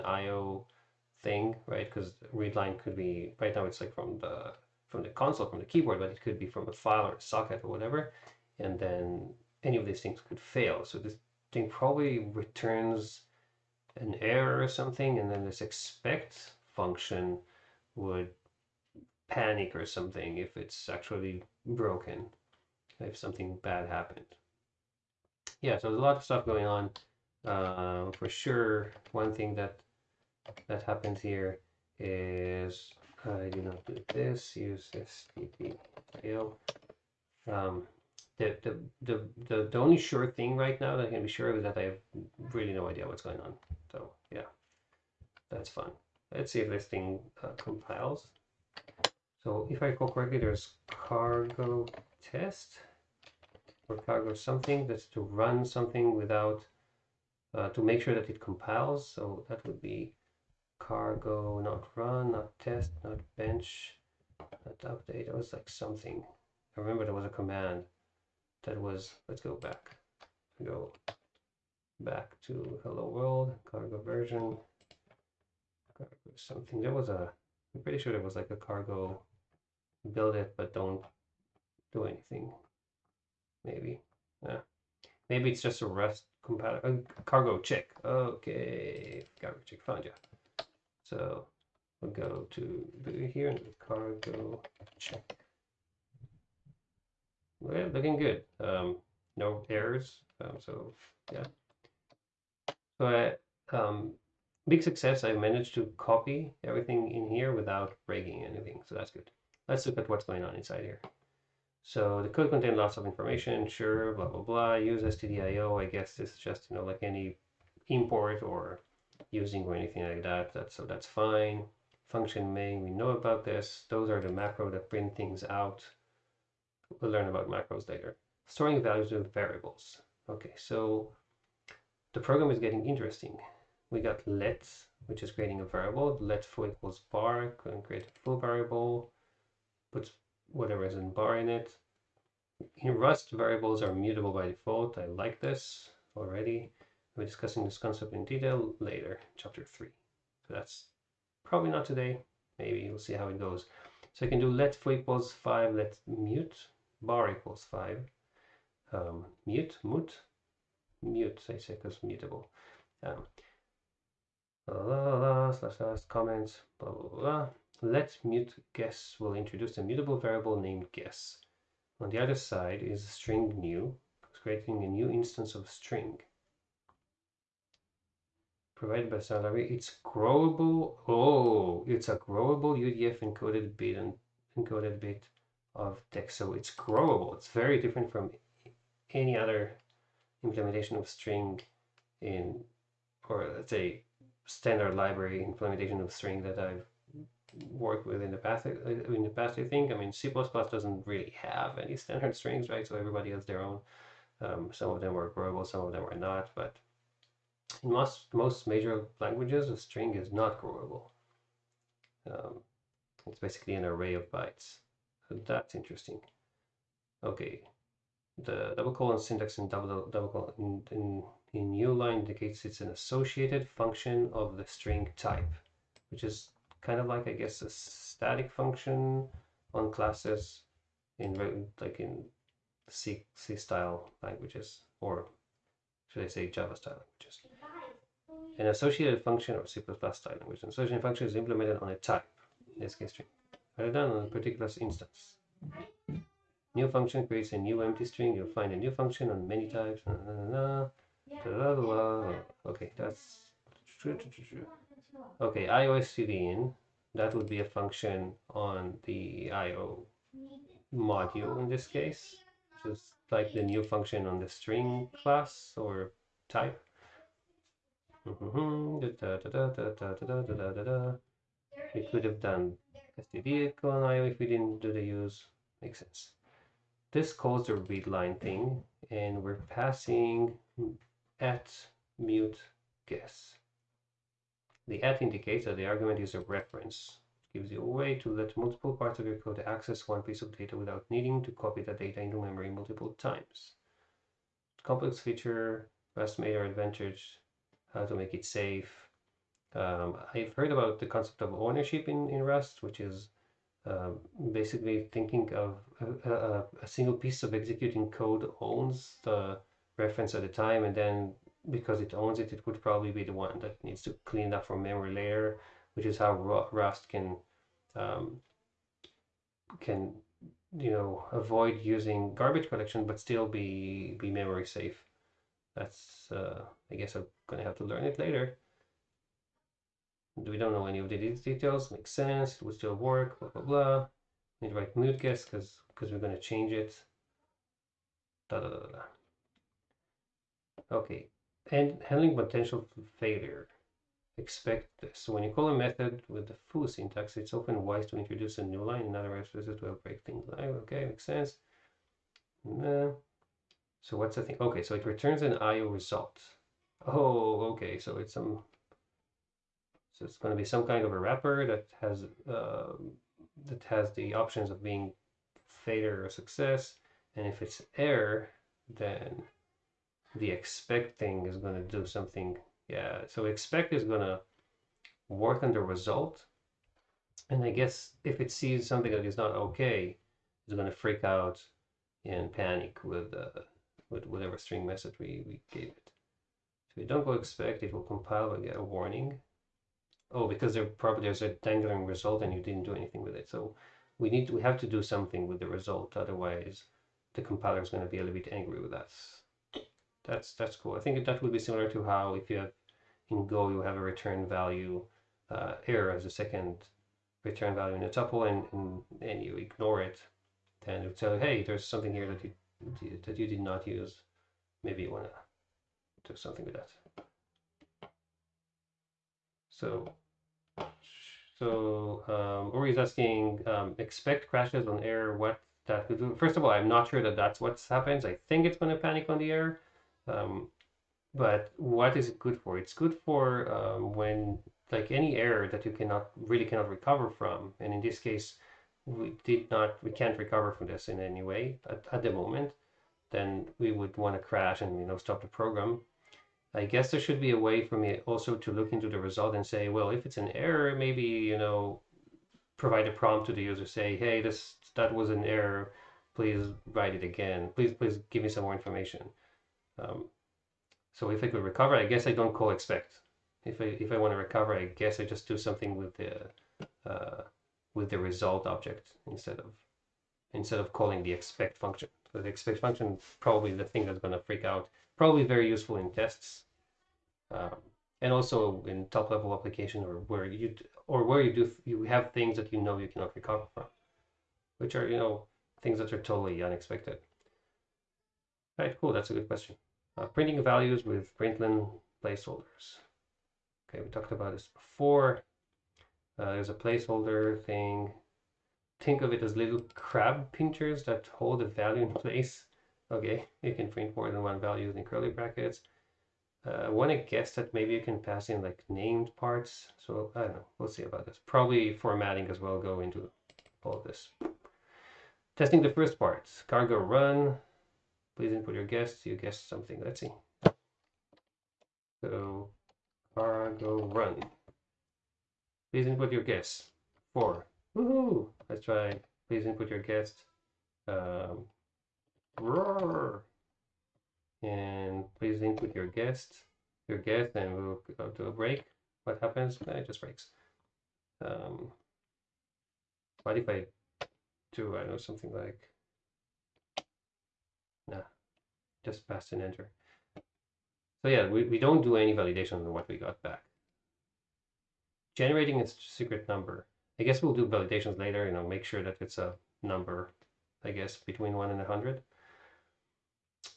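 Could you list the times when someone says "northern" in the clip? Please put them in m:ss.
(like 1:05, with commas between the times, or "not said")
not said.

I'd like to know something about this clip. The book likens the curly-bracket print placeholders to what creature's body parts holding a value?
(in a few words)
crab pinchers.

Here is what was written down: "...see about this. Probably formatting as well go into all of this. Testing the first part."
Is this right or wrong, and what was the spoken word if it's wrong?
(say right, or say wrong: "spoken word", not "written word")
right.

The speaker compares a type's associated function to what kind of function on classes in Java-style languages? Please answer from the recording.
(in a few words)
static function.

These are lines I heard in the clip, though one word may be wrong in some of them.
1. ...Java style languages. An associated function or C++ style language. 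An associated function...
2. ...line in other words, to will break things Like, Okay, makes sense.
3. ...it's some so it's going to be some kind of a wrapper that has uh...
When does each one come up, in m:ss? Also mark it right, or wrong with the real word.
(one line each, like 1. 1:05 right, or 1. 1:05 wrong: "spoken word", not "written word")
1. 3:56 right
2. 5:48 right
3. 5:58 right.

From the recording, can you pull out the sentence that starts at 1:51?
So the code contained lots of information.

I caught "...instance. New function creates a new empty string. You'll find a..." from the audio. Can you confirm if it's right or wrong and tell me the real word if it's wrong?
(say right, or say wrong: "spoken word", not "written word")
right.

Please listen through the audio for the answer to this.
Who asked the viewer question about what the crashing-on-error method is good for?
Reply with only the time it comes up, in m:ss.
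7:02.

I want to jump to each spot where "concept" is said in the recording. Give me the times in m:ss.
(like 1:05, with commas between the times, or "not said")
2:27, 5:01.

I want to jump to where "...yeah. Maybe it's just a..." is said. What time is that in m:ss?
1:24.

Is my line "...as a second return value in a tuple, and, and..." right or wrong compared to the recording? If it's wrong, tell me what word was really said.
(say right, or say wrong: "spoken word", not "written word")
right.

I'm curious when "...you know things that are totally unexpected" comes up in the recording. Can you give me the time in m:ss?
8:05.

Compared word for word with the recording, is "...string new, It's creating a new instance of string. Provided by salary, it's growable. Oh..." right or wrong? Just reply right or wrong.
right.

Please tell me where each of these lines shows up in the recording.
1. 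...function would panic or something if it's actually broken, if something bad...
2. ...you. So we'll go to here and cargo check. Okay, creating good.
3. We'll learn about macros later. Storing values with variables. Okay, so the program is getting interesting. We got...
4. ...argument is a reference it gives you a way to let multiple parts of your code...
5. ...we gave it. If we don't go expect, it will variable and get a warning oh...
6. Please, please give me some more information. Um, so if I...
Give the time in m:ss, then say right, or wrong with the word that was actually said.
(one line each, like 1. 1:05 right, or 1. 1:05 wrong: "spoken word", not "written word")
1. 0:16 right
2. 1:30 wrong: "looking", not "creating"
3. 2:06 right
4. 4:45 right
5. 6:25 wrong: "compile", not "variable"
6. 7:37 right.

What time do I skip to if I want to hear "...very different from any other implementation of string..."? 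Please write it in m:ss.
3:07.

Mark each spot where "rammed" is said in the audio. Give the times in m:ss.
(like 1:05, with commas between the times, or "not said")
not said.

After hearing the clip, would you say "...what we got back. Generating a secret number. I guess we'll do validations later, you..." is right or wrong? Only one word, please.
right.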